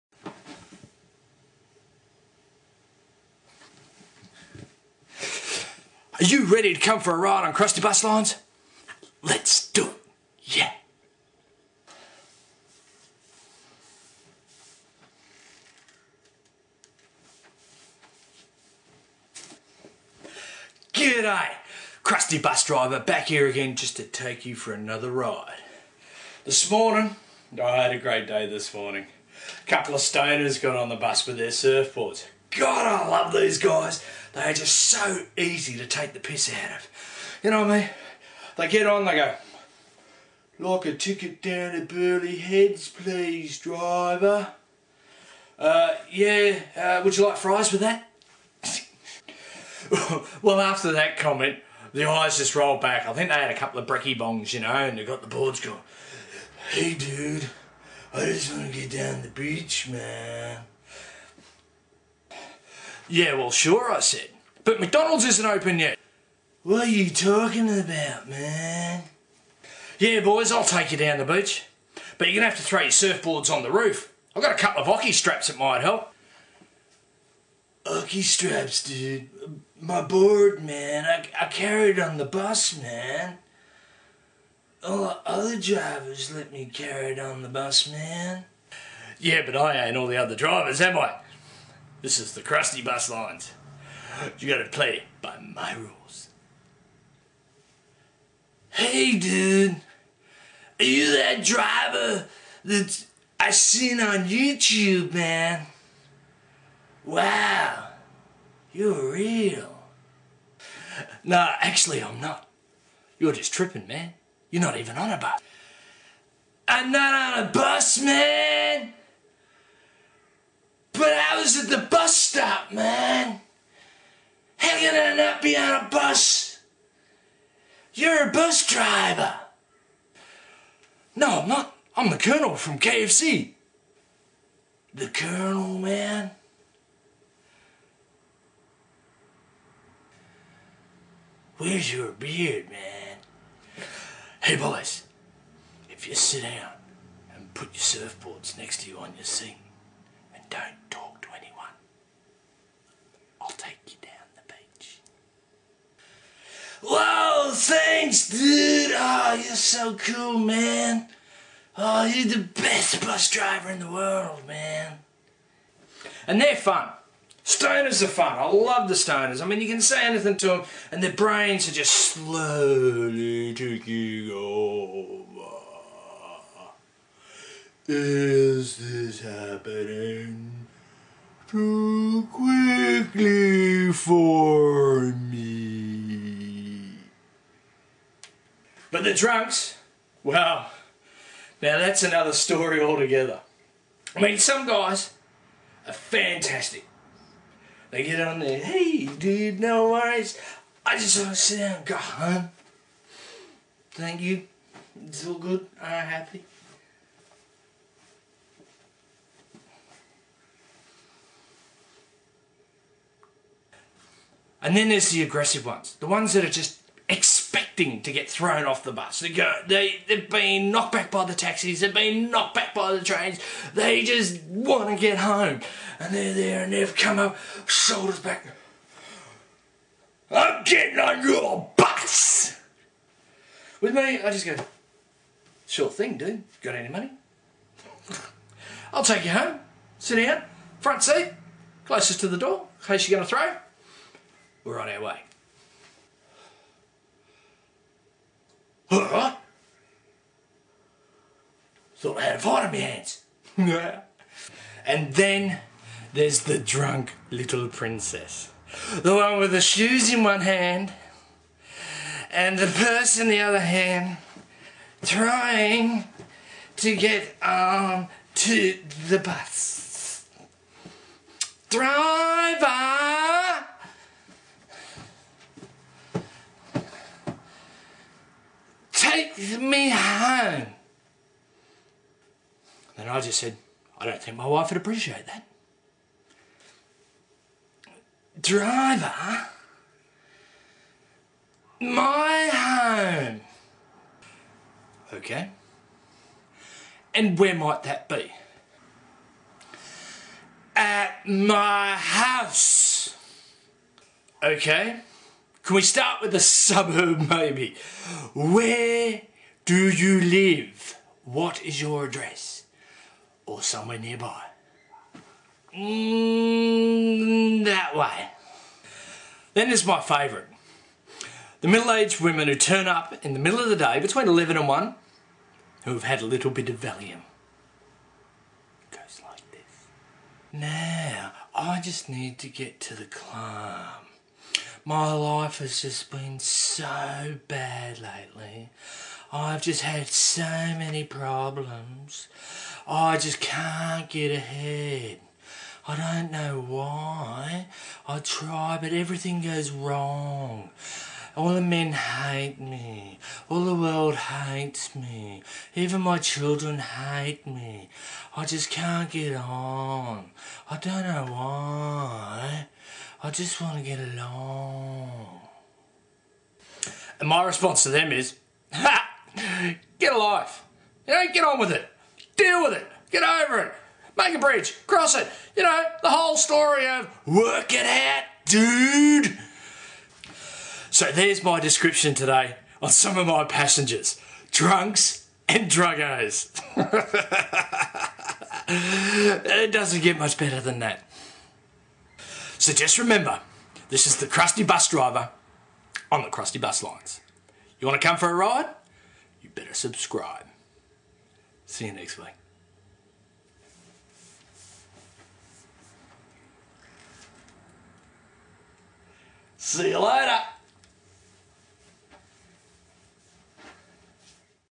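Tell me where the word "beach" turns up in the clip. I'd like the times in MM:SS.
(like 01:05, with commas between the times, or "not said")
00:59, 01:11.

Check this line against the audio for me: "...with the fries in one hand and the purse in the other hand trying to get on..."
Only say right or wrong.
wrong.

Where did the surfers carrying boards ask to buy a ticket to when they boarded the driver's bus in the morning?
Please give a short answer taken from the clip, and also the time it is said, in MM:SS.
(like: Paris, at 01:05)
Burleigh Heads, at 00:41.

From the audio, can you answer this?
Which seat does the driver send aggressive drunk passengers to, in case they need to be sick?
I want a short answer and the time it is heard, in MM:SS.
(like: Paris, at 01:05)
Front seat, closest to the door, at 04:00.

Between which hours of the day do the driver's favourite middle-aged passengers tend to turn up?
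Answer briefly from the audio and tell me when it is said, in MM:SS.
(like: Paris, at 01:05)
11 and 1, at 05:23.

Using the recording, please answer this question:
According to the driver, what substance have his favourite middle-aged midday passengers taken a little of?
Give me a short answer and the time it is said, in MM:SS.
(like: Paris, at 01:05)
Valium, at 05:26.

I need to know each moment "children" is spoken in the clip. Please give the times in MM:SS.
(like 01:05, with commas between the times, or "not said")
05:56.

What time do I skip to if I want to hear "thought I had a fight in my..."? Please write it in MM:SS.
04:12.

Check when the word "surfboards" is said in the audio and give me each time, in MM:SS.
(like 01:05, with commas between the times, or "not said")
00:31, 01:12, 02:28.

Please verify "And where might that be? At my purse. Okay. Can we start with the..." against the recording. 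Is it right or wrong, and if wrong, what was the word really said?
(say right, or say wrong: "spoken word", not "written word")
wrong: "house", not "purse".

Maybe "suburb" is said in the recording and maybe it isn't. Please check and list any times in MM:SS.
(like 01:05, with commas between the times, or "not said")
05:06.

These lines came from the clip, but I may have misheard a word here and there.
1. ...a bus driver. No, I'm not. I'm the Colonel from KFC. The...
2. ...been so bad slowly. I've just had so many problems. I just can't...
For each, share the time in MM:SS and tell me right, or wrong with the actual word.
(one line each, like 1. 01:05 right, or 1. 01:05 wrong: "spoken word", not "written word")
1. 02:08 right
2. 05:36 wrong: "lately", not "slowly".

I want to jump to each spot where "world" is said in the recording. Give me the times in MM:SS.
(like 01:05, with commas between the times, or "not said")
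02:43, 05:53.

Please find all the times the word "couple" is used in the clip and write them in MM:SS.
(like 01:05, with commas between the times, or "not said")
00:29, 00:53, 01:14.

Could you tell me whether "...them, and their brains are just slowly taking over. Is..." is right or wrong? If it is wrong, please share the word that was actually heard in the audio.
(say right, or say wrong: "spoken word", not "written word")
right.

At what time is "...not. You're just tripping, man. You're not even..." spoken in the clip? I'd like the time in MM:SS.
01:52.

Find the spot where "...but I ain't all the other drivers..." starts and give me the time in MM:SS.
01:29.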